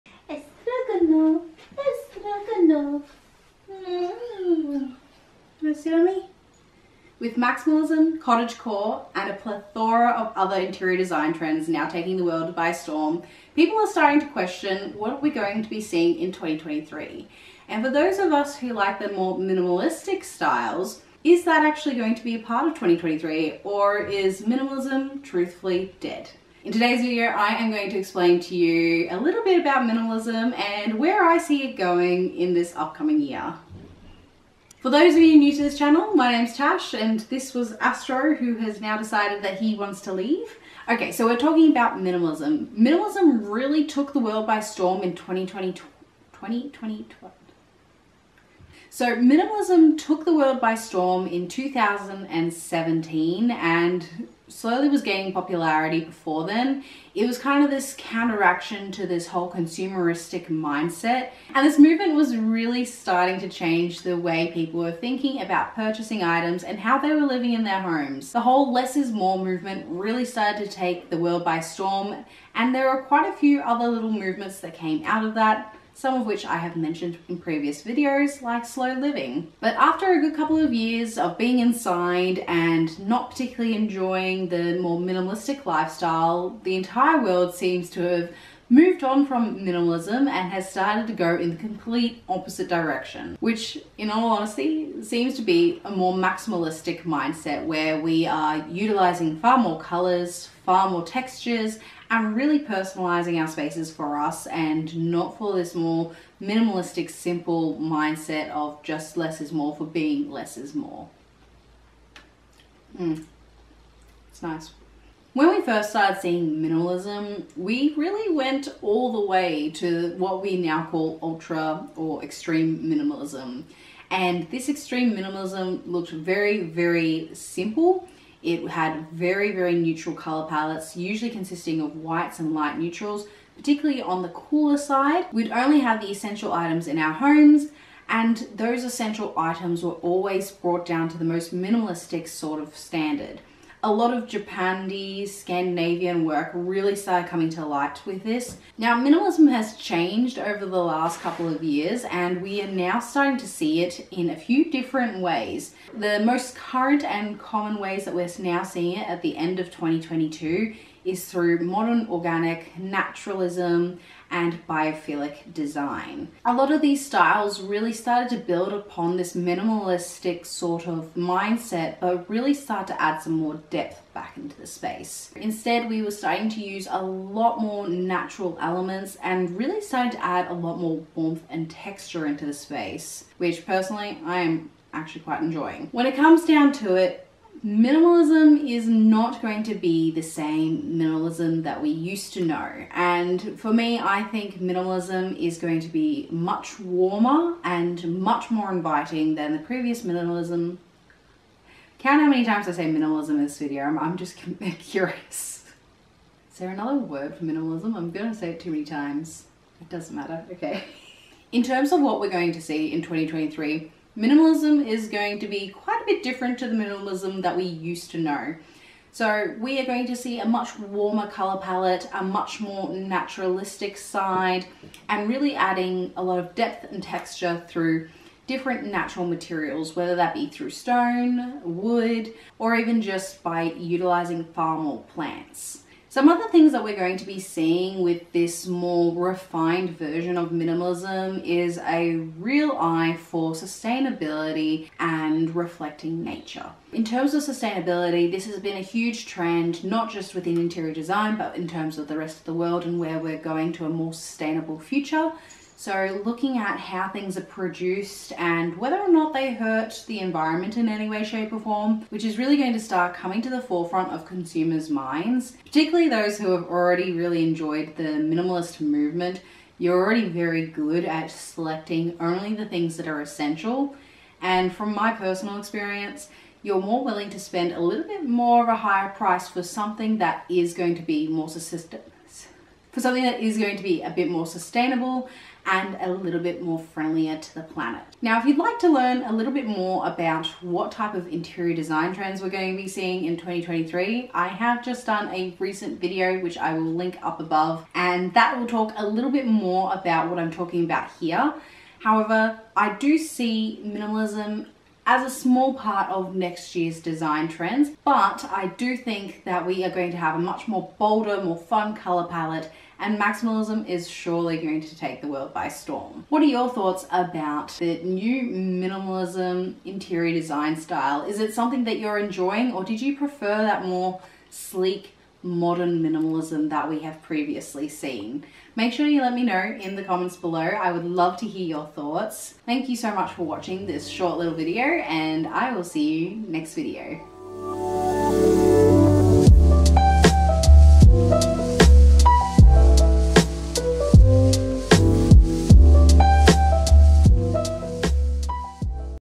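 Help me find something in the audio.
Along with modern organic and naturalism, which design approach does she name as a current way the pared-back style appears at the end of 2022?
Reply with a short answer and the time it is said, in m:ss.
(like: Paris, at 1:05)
Biophilic design, at 2:44.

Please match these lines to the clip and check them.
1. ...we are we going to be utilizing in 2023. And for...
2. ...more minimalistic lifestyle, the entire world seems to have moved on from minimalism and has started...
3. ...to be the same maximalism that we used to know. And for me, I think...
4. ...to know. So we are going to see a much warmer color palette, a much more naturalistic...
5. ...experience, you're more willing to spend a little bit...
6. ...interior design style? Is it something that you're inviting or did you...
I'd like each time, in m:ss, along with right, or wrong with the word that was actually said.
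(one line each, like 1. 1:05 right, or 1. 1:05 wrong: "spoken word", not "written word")
1. 0:15 wrong: "seeing", not "utilizing"
2. 1:24 right
3. 3:09 wrong: "minimalism", not "maximalism"
4. 3:38 right
5. 4:35 right
6. 5:19 wrong: "enjoying", not "inviting".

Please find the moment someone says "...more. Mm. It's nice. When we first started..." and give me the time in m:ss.
1:50.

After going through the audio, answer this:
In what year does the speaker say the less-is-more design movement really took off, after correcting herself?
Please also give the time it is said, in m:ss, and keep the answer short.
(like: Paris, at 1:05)
2017, at 0:51.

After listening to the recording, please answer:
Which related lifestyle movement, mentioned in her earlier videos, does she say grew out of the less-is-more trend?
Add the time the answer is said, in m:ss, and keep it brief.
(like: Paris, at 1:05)
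Slow living, at 1:18.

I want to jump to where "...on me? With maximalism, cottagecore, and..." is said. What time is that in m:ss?
0:05.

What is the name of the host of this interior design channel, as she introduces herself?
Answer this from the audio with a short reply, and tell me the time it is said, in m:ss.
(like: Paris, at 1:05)
Tash, at 0:36.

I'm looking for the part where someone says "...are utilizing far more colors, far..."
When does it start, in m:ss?
1:38.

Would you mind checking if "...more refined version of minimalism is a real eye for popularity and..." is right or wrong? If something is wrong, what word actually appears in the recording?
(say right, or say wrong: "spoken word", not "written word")
wrong: "sustainability", not "popularity".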